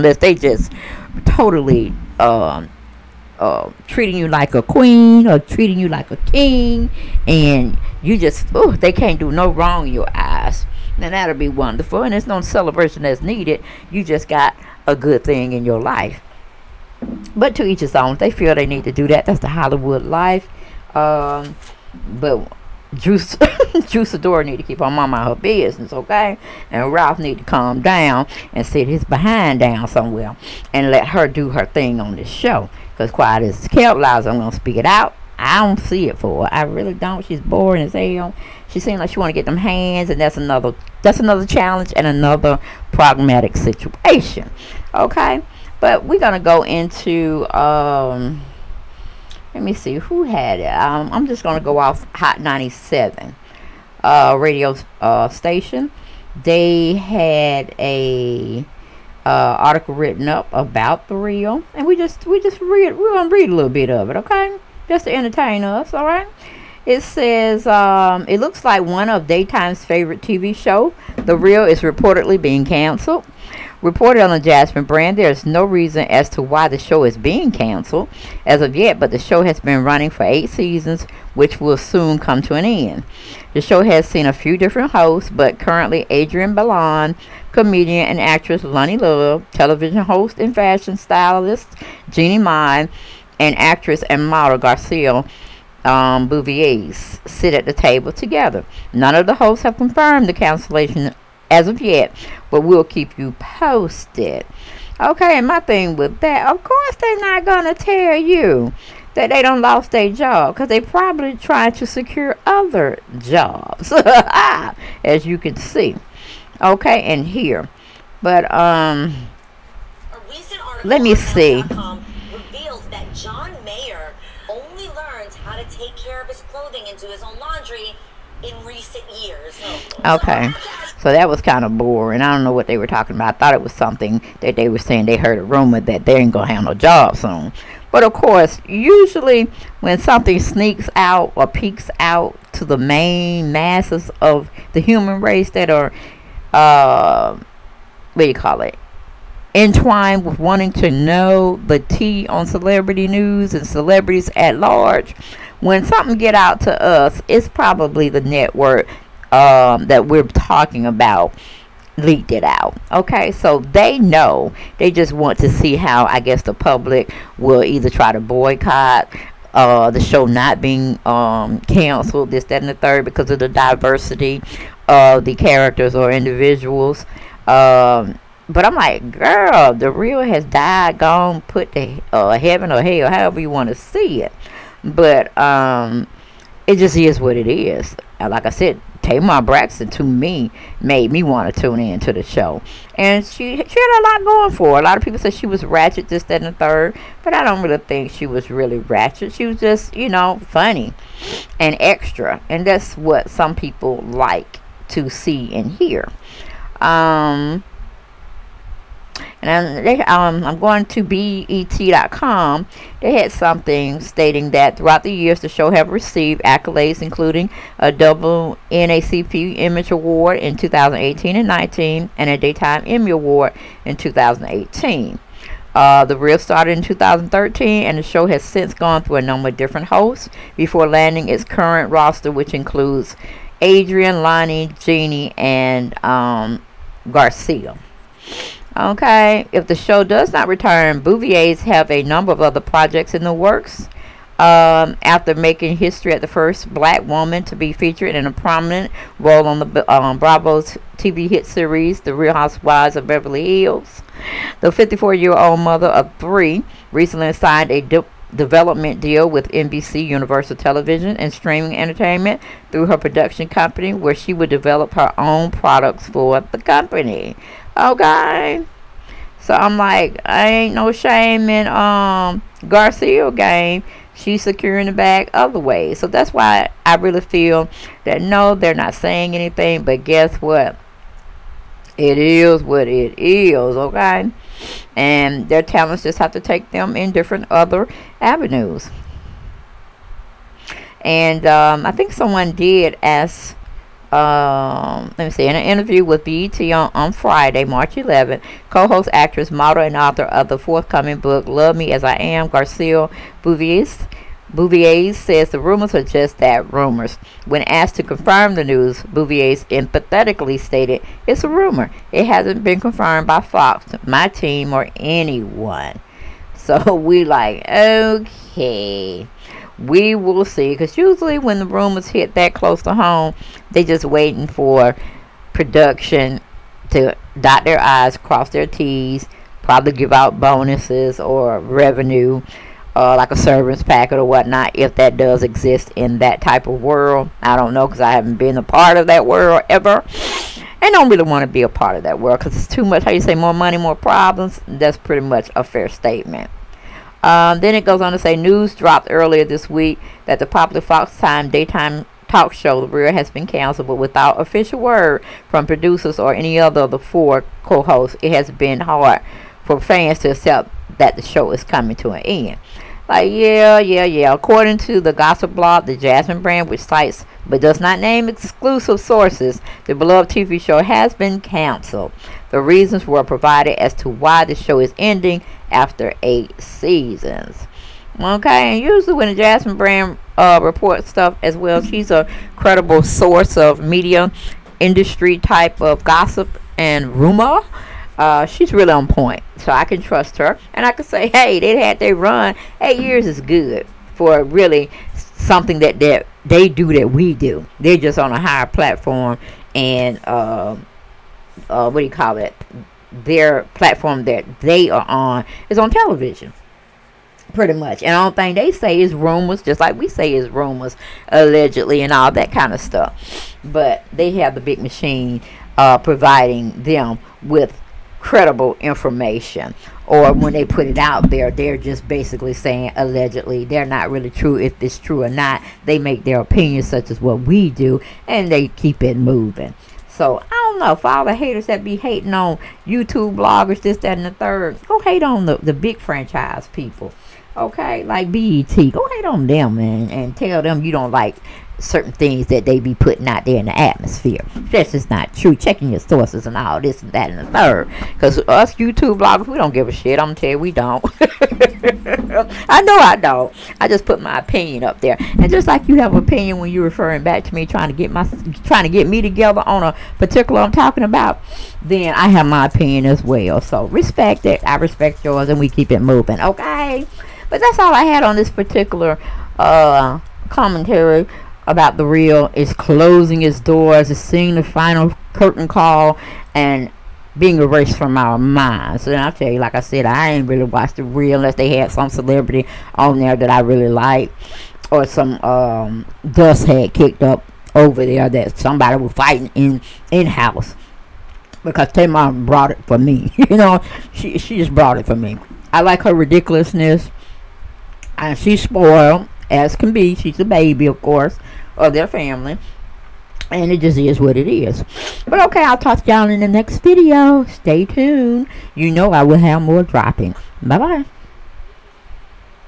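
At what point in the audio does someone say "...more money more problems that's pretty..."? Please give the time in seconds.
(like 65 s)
343 s.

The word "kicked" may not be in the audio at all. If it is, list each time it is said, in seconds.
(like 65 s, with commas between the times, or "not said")
486 s.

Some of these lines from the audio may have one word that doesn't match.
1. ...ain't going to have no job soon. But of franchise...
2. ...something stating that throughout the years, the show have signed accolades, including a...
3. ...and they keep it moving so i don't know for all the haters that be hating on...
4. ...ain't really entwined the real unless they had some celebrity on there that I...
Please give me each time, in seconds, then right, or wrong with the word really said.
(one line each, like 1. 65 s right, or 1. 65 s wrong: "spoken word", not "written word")
1. 136 s wrong: "course", not "franchise"
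2. 213 s wrong: "received", not "signed"
3. 428 s right
4. 480 s wrong: "watched", not "entwined".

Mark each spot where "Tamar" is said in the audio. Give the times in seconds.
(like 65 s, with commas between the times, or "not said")
189 s, 491 s.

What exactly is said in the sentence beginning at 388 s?
Uh, she's really on point, so I can trust her.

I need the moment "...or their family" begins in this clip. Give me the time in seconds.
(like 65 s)
501 s.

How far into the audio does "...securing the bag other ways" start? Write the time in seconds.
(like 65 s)
274 s.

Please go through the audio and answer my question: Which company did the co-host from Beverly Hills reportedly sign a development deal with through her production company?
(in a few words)
NBC Universal.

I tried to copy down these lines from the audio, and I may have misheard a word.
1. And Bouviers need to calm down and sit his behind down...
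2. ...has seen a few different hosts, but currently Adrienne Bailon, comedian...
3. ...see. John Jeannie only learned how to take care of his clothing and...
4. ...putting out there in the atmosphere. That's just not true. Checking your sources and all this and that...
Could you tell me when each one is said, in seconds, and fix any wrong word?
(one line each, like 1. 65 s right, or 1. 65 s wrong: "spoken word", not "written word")
1. 26 s wrong: "Ralph", not "Bouviers"
2. 83 s right
3. 121 s wrong: "Mayer", not "Jeannie"
4. 442 s right.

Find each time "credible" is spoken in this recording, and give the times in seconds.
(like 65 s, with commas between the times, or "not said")
382 s, 418 s.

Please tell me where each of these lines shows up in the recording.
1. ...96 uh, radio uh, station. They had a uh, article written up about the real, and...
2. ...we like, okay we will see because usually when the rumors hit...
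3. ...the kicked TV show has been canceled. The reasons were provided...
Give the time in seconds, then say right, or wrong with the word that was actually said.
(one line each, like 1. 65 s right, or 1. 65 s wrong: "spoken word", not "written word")
1. 52 s wrong: "97", not "96"
2. 316 s right
3. 369 s wrong: "beloved", not "kicked".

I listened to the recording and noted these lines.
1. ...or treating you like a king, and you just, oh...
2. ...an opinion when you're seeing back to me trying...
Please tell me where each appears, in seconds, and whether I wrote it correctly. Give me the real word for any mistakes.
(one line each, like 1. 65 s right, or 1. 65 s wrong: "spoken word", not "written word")
1. 5 s right
2. 456 s wrong: "referring", not "seeing".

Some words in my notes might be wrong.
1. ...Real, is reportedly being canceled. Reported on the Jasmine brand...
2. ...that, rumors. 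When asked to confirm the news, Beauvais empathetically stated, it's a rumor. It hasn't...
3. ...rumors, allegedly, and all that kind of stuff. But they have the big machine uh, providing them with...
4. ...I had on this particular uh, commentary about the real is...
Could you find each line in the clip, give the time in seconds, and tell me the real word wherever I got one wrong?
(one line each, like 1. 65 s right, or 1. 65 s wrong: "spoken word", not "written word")
1. 71 s right
2. 306 s right
3. 410 s right
4. 467 s right.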